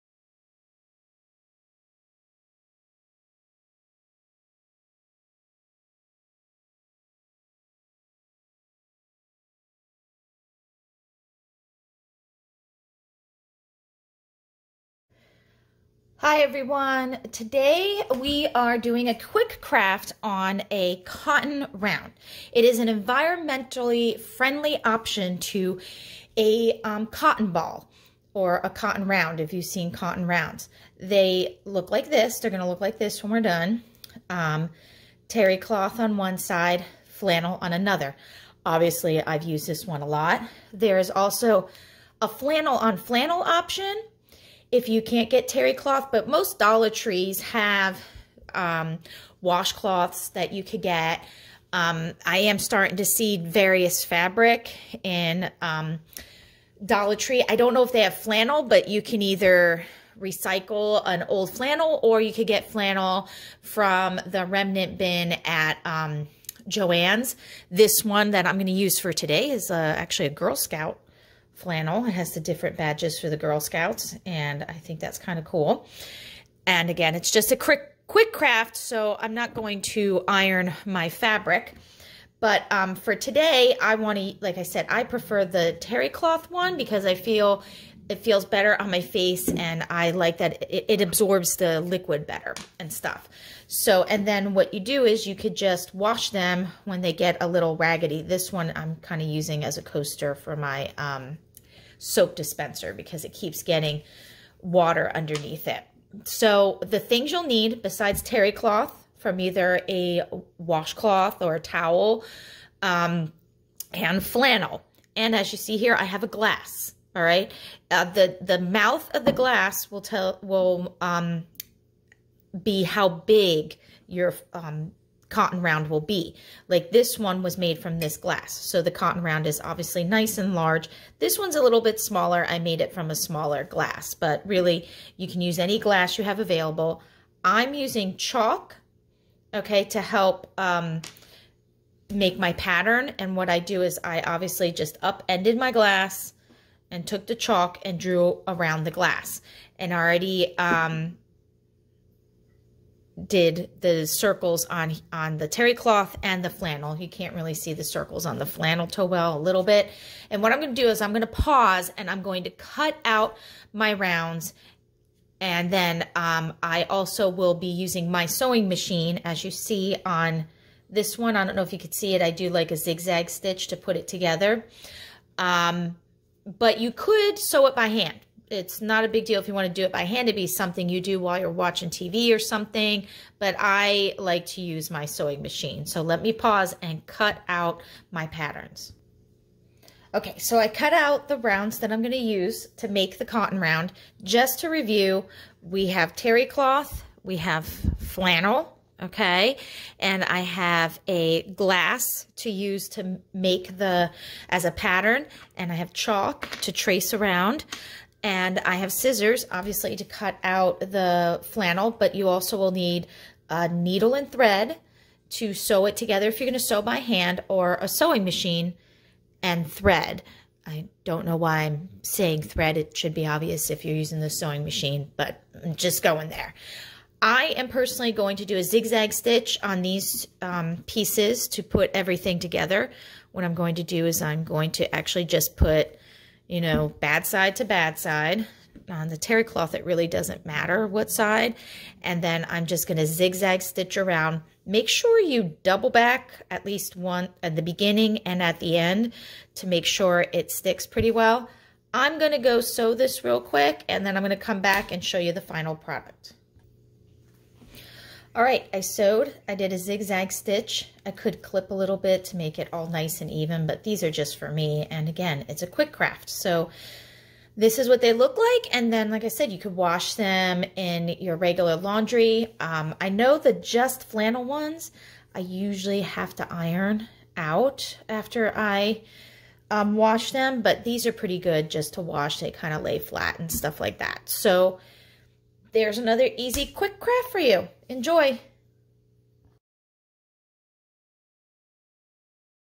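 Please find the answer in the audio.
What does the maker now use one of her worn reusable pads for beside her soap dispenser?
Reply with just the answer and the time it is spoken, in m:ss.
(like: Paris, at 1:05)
a coaster, at 1:39.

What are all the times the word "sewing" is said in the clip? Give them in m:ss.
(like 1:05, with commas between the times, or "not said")
2:48, 3:05, 3:37, 3:44.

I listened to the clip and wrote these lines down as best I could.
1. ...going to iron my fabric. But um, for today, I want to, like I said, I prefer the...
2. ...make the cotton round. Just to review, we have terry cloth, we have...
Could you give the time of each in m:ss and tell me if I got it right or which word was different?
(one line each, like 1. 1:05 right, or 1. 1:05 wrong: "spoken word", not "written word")
1. 1:19 right
2. 3:12 right.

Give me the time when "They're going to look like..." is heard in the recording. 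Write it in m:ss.
0:32.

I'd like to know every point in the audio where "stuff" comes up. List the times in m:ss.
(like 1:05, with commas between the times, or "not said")
1:32, 4:43.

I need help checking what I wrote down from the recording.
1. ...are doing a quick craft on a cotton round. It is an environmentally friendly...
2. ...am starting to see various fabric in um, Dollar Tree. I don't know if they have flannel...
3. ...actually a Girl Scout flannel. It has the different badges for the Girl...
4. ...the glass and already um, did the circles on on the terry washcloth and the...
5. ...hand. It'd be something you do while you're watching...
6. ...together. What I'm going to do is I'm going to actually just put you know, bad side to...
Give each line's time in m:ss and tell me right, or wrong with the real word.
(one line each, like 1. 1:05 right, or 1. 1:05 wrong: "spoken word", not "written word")
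1. 0:18 right
2. 0:52 right
3. 1:09 right
4. 2:28 wrong: "cloth", not "washcloth"
5. 3:00 right
6. 3:52 right.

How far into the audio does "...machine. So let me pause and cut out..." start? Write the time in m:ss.
3:05.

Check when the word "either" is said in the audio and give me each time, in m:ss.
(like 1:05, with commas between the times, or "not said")
0:59, 1:49.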